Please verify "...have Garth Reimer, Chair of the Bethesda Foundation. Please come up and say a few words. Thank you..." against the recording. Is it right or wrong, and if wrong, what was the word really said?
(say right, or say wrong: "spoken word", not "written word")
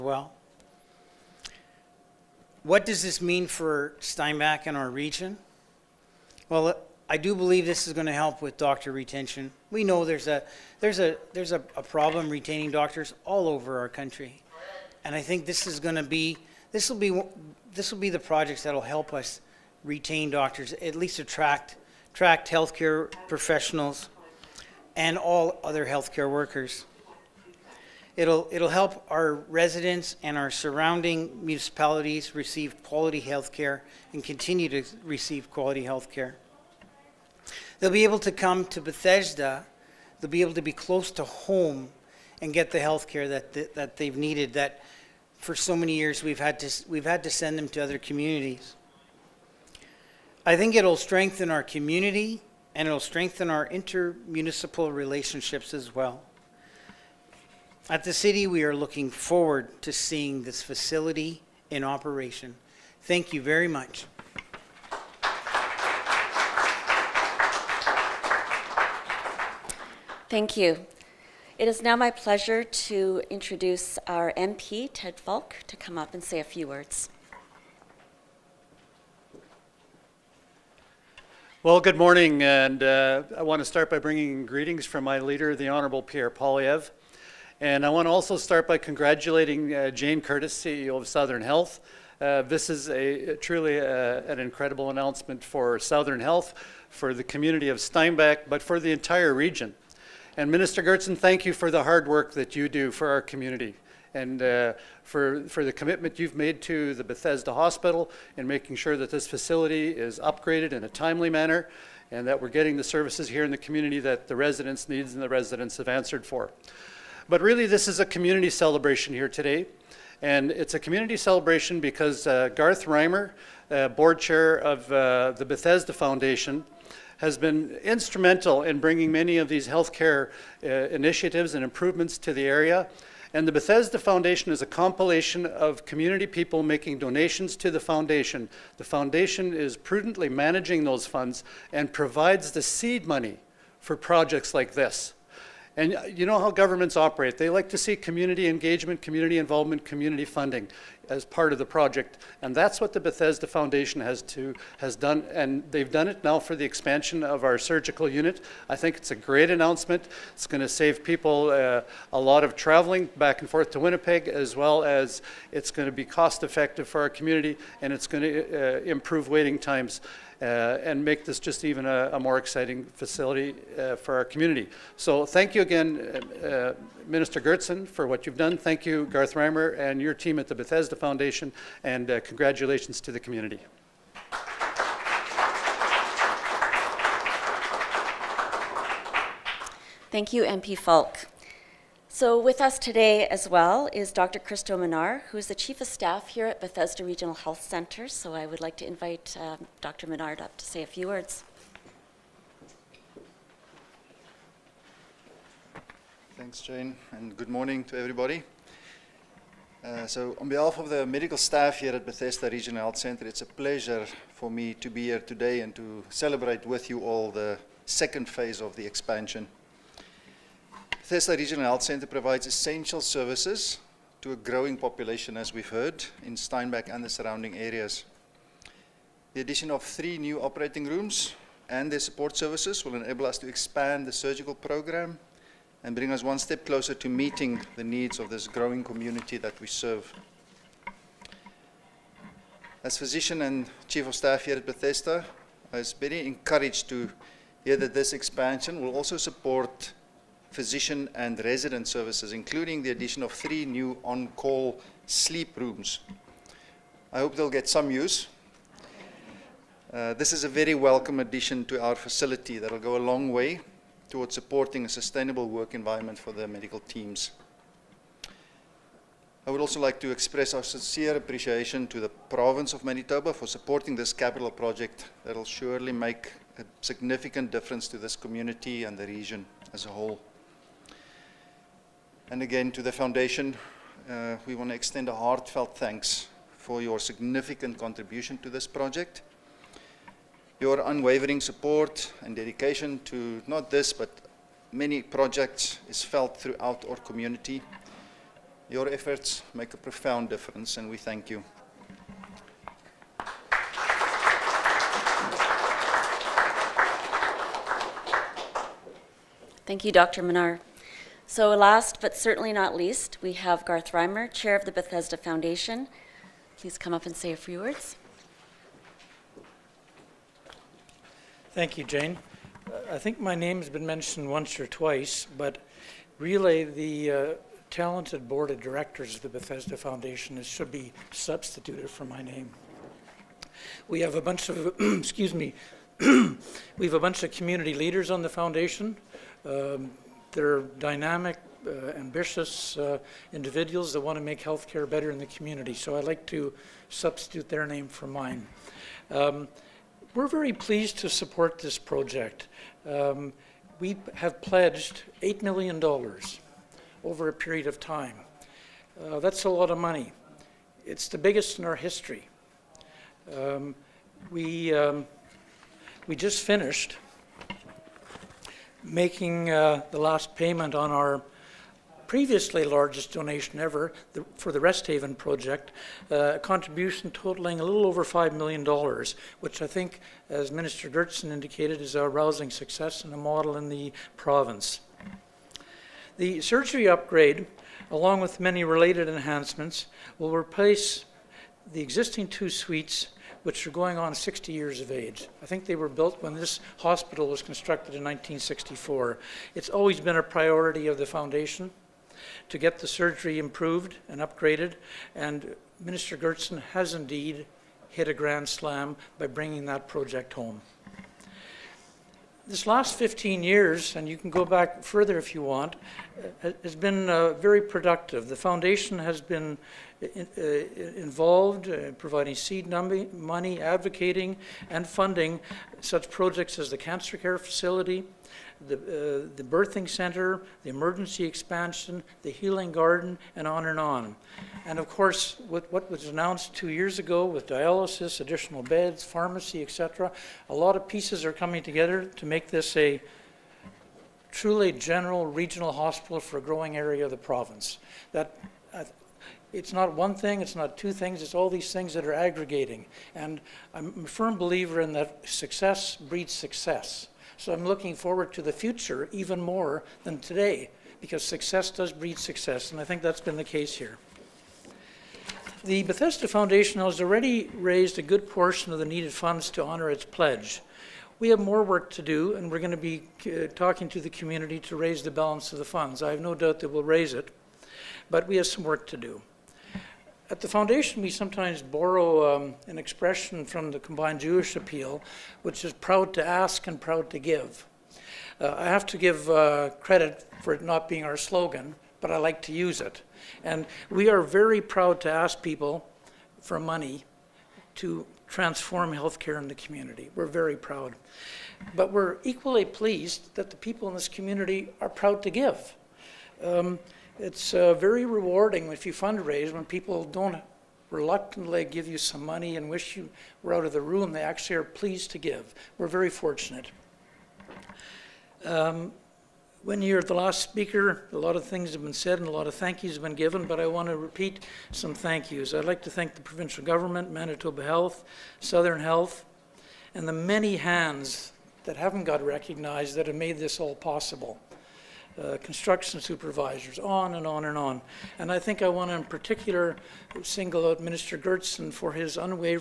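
right.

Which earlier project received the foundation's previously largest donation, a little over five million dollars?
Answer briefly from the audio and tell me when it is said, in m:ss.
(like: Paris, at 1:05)
Rest Haven, at 6:14.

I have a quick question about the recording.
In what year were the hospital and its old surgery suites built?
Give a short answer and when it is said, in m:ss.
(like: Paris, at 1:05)
1964, at 6:38.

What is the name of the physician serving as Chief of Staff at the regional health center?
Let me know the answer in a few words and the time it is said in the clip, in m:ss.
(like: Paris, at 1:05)
Cristo Minnaar, at 3:14.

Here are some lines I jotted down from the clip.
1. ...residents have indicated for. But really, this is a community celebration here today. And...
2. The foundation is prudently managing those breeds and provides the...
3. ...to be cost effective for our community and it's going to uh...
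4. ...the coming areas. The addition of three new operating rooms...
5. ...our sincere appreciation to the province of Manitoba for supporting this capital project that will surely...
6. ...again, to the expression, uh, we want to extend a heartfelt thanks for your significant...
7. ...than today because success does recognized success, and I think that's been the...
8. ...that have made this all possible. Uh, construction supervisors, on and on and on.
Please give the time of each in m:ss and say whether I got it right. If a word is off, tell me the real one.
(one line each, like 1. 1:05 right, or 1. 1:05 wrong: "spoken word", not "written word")
1. 1:55 wrong: "answered", not "indicated"
2. 2:18 wrong: "funds", not "breeds"
3. 2:45 right
4. 3:47 wrong: "surrounding", not "coming"
5. 4:30 right
6. 4:42 wrong: "foundation", not "expression"
7. 7:40 wrong: "breed", not "recognized"
8. 8:52 right.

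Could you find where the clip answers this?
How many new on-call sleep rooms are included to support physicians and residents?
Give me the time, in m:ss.
4:13.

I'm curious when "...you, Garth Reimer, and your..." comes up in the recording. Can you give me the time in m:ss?
2:58.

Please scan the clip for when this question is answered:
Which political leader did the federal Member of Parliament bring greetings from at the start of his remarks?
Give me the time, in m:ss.
1:26.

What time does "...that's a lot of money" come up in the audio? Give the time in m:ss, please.
5:59.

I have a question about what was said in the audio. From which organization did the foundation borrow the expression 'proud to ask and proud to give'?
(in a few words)
Combined Jewish Appeal.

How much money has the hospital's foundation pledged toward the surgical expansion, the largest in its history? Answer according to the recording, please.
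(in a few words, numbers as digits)
$8 million.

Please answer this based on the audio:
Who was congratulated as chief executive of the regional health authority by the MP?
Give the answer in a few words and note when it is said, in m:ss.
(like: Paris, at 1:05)
Jane Curtis, at 1:29.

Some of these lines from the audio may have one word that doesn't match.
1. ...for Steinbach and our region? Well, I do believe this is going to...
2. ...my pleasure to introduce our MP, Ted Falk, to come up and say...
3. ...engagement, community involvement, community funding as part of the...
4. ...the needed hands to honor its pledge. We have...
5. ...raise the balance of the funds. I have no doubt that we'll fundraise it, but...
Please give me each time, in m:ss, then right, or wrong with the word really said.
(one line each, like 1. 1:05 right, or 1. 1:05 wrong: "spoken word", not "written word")
1. 0:03 right
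2. 1:11 right
3. 2:28 right
4. 7:48 wrong: "funds", not "hands"
5. 7:54 wrong: "raise", not "fundraise".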